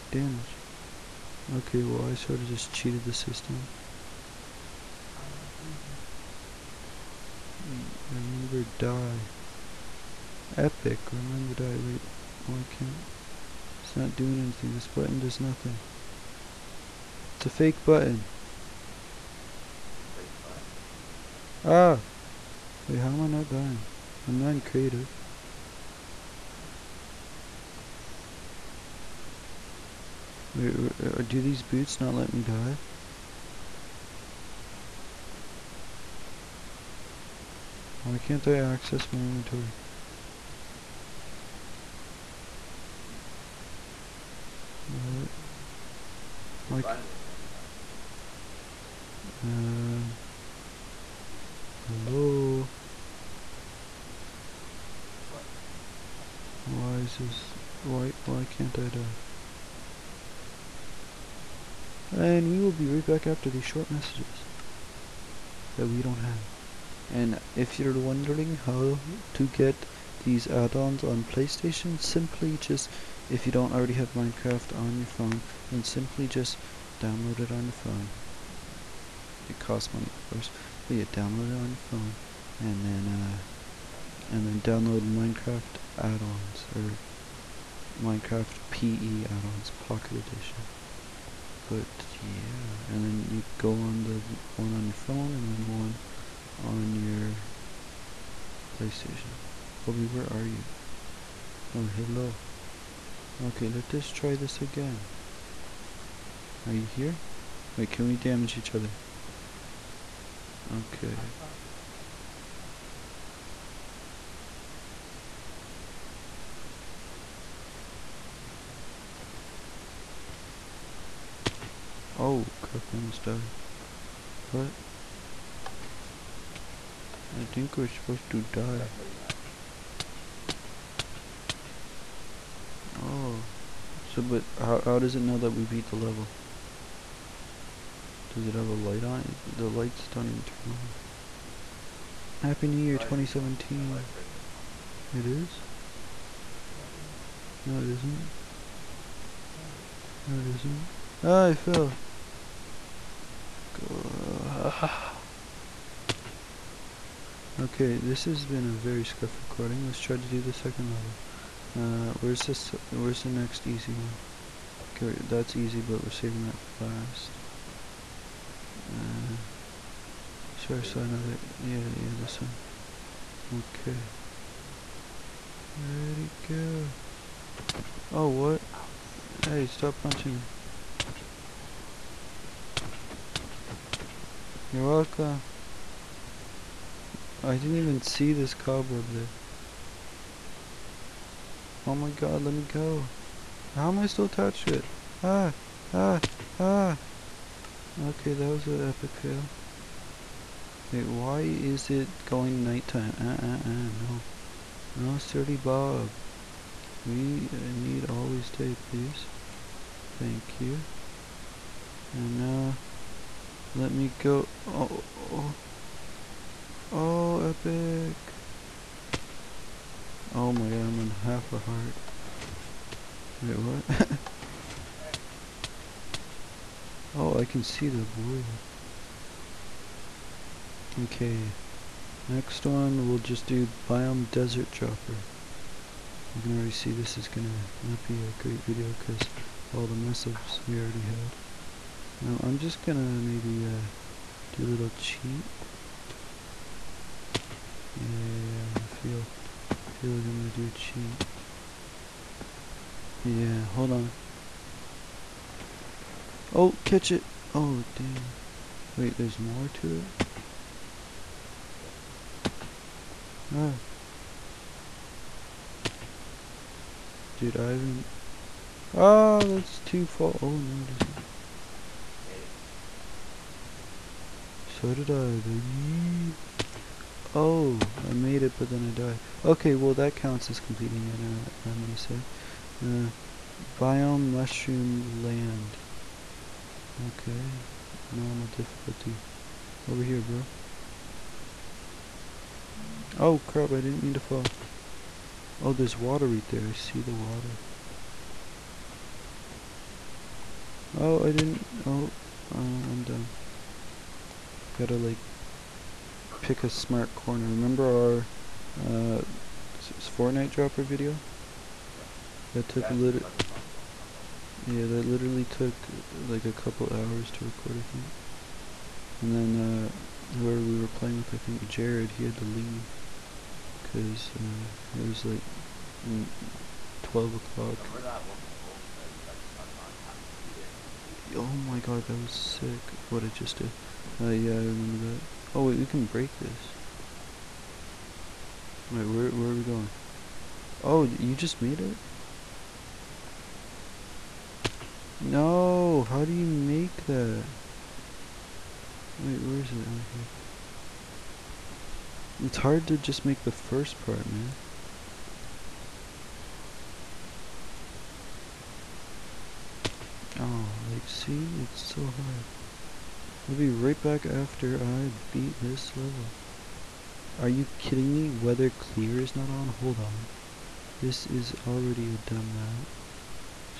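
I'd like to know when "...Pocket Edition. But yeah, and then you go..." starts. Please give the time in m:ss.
1:29.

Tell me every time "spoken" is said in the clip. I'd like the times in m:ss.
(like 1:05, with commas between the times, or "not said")
not said.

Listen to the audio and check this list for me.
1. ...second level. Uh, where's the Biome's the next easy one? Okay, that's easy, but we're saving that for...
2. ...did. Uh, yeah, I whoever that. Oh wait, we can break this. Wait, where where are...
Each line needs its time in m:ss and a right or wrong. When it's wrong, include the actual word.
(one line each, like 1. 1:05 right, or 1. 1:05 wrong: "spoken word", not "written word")
1. 2:40 wrong: "Where", not "Biome"
2. 5:33 wrong: "remember", not "whoever".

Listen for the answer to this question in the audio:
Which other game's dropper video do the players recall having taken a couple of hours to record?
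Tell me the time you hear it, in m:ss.
5:09.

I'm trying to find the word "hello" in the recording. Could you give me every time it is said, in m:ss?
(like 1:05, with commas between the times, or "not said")
0:51, 1:41.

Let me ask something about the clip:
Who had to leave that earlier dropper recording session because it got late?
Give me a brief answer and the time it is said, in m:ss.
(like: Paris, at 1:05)
Jared, at 5:21.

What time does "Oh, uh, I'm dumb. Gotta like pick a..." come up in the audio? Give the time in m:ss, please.
5:01.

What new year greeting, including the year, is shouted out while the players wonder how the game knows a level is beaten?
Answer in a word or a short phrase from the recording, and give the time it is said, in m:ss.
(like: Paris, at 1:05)
Happy New Year 2017, at 2:22.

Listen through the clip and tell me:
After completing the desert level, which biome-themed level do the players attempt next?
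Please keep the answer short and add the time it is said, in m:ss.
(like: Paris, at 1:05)
Mushroom land, at 4:44.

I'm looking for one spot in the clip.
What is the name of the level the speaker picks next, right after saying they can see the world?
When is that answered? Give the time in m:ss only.
3:53.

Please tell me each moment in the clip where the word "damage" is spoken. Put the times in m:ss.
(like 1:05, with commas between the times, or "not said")
0:00, 1:48.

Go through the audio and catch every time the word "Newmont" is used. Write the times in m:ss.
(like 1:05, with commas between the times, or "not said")
not said.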